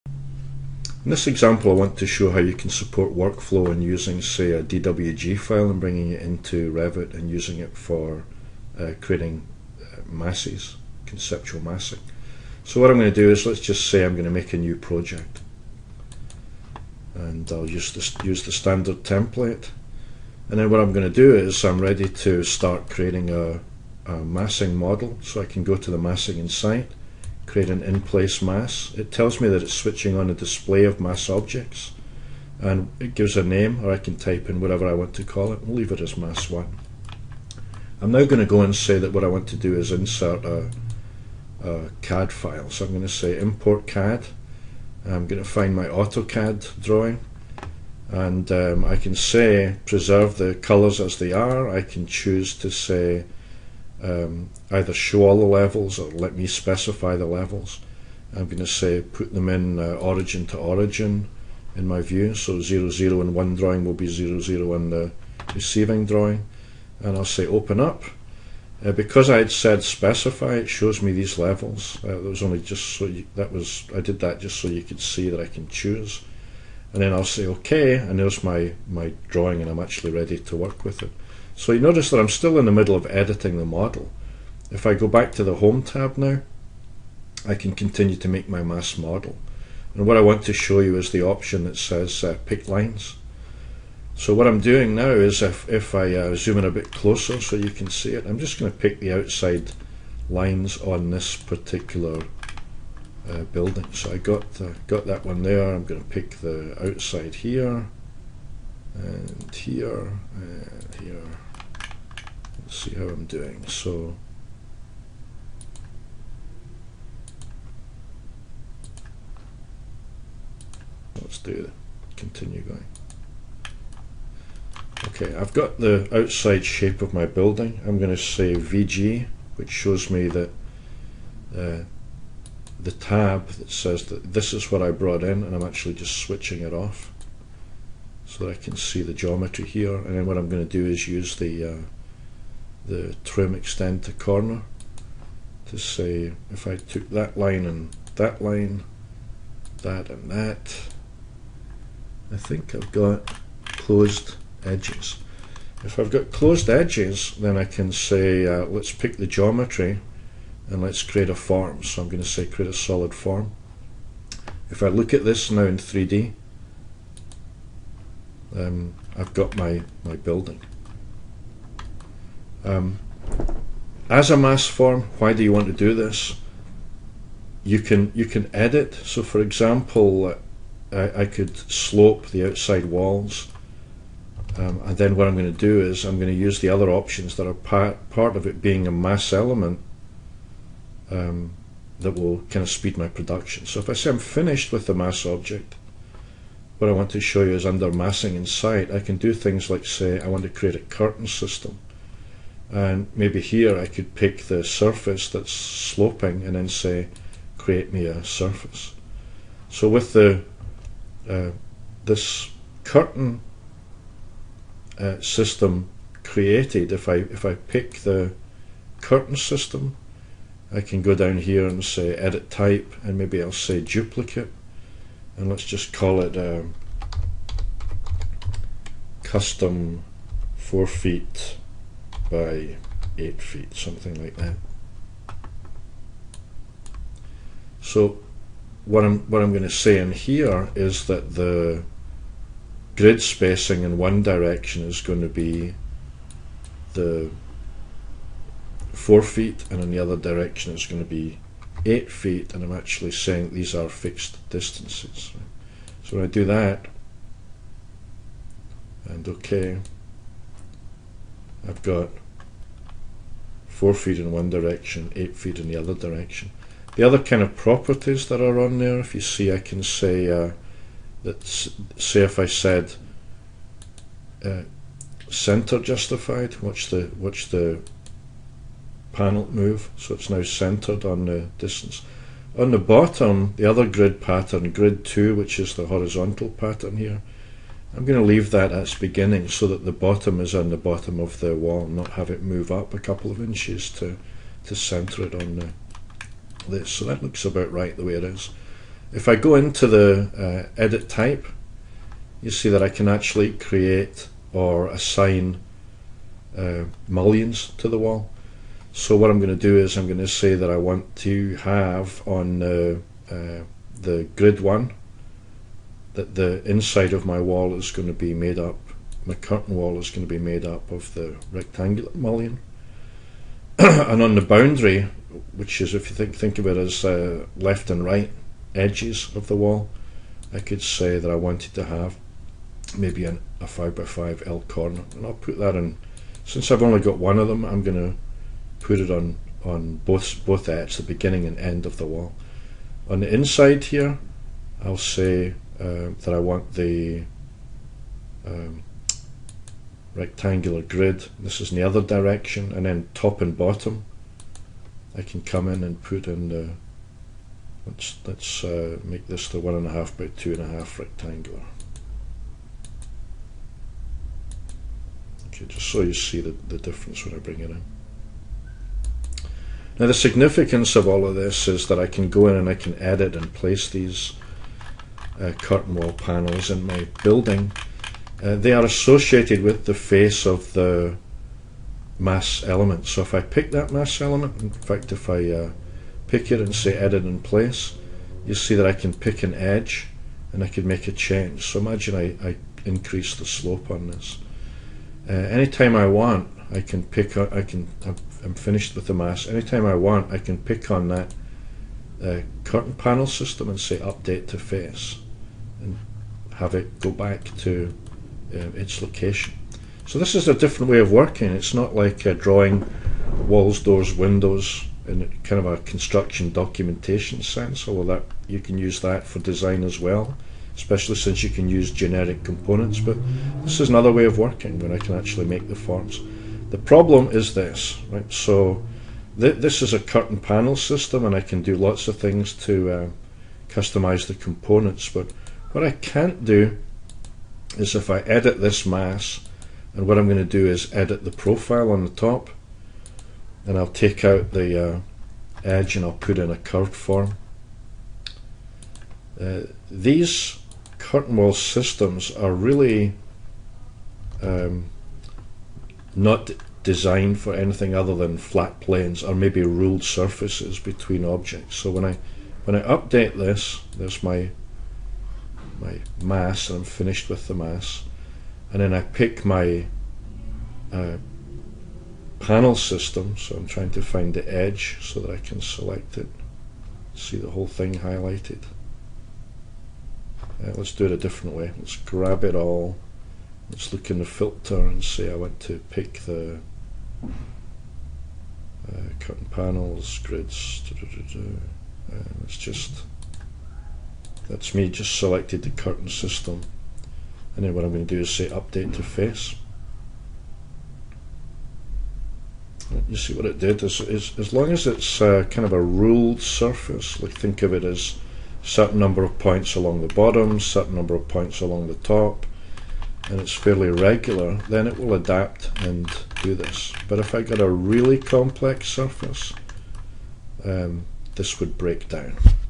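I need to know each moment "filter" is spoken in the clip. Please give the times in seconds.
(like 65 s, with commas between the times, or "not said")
484 s.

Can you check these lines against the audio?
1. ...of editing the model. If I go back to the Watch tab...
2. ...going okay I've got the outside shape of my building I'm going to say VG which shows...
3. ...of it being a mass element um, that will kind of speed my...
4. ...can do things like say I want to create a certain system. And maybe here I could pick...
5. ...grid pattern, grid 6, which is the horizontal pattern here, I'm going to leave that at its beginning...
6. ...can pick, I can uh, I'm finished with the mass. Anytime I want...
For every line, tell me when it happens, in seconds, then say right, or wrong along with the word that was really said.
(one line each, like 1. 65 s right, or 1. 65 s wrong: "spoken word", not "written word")
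1. 82 s wrong: "Home", not "Watch"
2. 122 s right
3. 188 s right
4. 198 s wrong: "curtain", not "certain"
5. 283 s wrong: "2", not "6"
6. 396 s right.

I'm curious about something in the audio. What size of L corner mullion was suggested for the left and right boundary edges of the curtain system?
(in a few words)
5 by 5.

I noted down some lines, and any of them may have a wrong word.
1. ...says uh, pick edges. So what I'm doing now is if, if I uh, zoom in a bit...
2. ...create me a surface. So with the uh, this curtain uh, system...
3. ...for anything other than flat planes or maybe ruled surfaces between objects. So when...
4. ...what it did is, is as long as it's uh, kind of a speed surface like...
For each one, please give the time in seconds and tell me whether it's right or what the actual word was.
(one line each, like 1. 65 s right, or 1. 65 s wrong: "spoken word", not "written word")
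1. 91 s wrong: "lines", not "edges"
2. 207 s right
3. 457 s right
4. 503 s wrong: "ruled", not "speed".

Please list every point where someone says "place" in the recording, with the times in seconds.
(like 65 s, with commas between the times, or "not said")
27 s, 373 s, 387 s.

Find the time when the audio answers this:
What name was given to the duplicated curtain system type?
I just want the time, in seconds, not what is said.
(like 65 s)
229 s.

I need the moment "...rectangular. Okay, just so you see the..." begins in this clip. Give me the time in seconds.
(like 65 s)
360 s.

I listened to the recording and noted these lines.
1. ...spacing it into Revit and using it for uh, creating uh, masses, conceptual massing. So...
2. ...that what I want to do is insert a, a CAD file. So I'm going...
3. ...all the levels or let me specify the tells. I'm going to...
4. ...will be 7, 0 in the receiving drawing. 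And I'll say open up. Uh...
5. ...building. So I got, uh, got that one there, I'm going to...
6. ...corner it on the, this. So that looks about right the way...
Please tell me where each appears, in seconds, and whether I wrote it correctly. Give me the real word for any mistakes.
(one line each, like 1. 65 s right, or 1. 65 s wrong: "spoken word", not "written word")
1. 5 s wrong: "bringing", not "spacing"
2. 38 s right
3. 55 s wrong: "levels", not "tells"
4. 63 s wrong: "0", not "7"
5. 103 s right
6. 294 s wrong: "center", not "corner".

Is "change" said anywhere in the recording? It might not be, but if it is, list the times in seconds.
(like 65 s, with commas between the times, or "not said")
391 s.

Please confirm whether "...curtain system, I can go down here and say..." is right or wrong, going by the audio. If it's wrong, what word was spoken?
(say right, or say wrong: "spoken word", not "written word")
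right.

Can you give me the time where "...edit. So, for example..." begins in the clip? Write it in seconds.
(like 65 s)
178 s.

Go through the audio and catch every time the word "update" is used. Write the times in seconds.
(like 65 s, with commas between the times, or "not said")
403 s, 462 s, 498 s.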